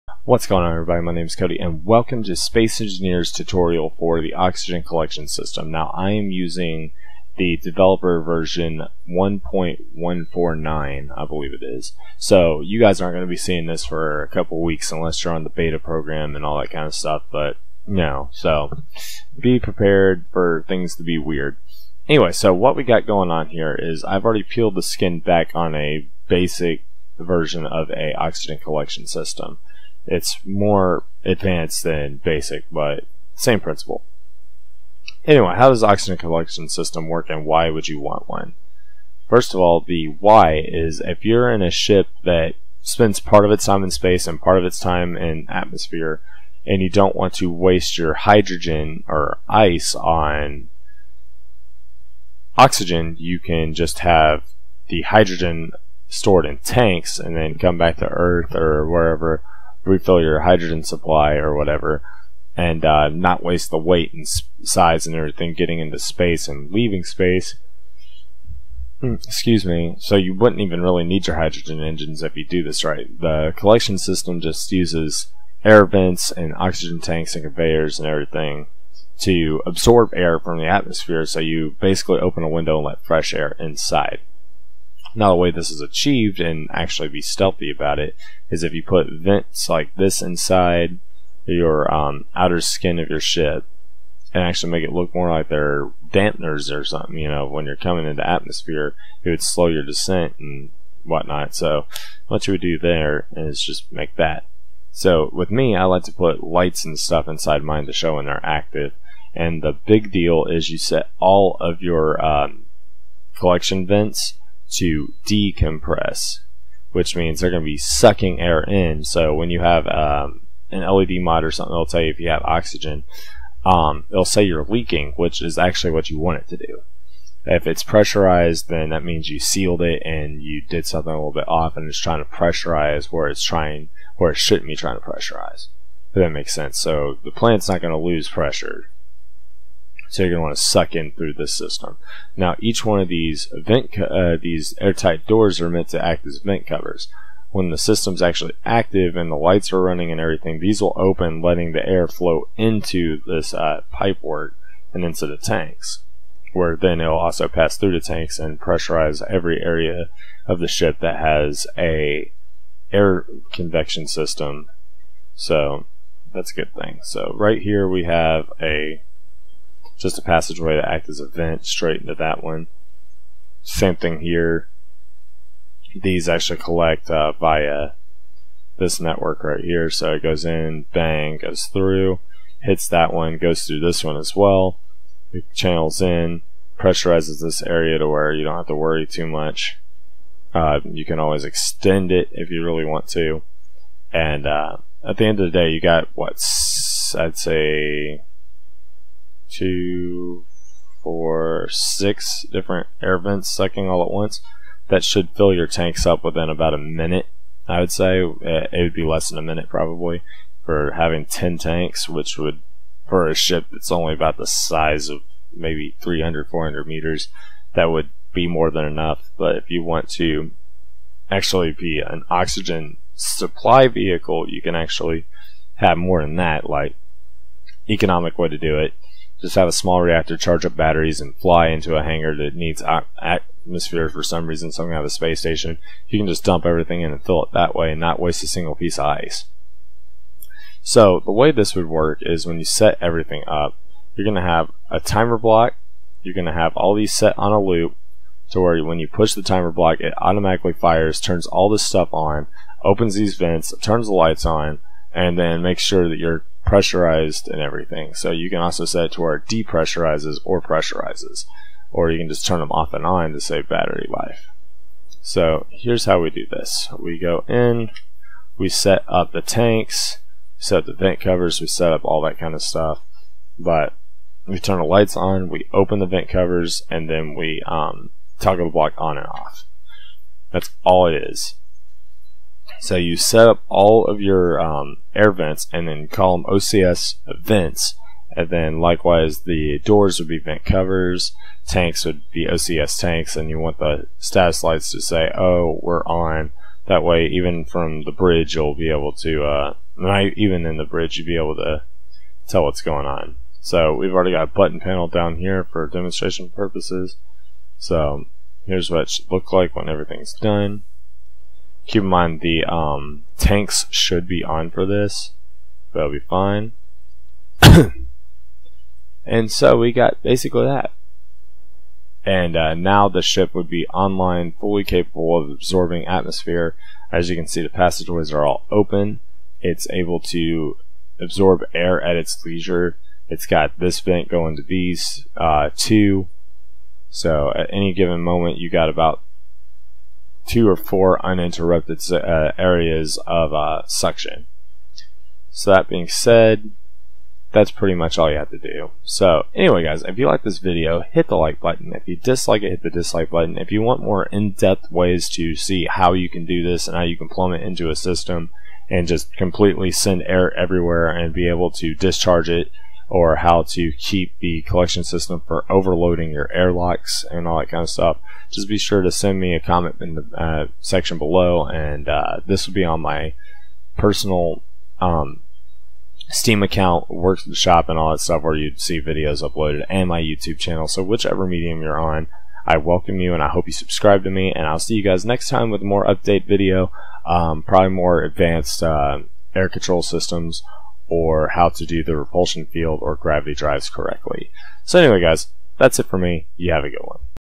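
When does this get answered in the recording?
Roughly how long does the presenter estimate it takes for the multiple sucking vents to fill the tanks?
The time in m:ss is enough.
3:26.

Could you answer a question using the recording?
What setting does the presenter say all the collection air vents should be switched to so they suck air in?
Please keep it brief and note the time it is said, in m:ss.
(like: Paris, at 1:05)
Decompress, at 1:55.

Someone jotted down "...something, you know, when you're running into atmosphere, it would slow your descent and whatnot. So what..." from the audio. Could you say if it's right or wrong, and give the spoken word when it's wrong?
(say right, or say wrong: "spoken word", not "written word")
wrong: "coming", not "running".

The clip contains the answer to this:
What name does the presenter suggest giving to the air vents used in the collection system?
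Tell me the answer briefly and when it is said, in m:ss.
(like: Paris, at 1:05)
OCS vents, at 4:46.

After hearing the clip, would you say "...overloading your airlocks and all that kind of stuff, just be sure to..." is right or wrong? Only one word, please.
right.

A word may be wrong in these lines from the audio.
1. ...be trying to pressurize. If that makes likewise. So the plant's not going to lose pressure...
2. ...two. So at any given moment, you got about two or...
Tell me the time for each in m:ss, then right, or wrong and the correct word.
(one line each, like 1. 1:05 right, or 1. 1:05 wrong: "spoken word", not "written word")
1. 2:14 wrong: "sense", not "likewise"
2. 5:35 right.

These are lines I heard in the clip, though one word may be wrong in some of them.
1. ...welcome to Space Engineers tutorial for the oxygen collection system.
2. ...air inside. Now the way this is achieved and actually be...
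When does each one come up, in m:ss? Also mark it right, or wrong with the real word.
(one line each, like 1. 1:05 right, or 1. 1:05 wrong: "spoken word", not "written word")
1. 0:01 right
2. 1:23 right.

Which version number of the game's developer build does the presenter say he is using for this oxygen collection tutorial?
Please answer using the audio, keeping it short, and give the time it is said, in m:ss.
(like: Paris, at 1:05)
1.149, at 0:09.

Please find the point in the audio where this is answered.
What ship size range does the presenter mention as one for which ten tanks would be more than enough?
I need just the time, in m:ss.
3:36.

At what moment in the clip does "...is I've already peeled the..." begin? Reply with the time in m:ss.
0:23.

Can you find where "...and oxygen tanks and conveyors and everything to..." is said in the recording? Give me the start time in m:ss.
1:16.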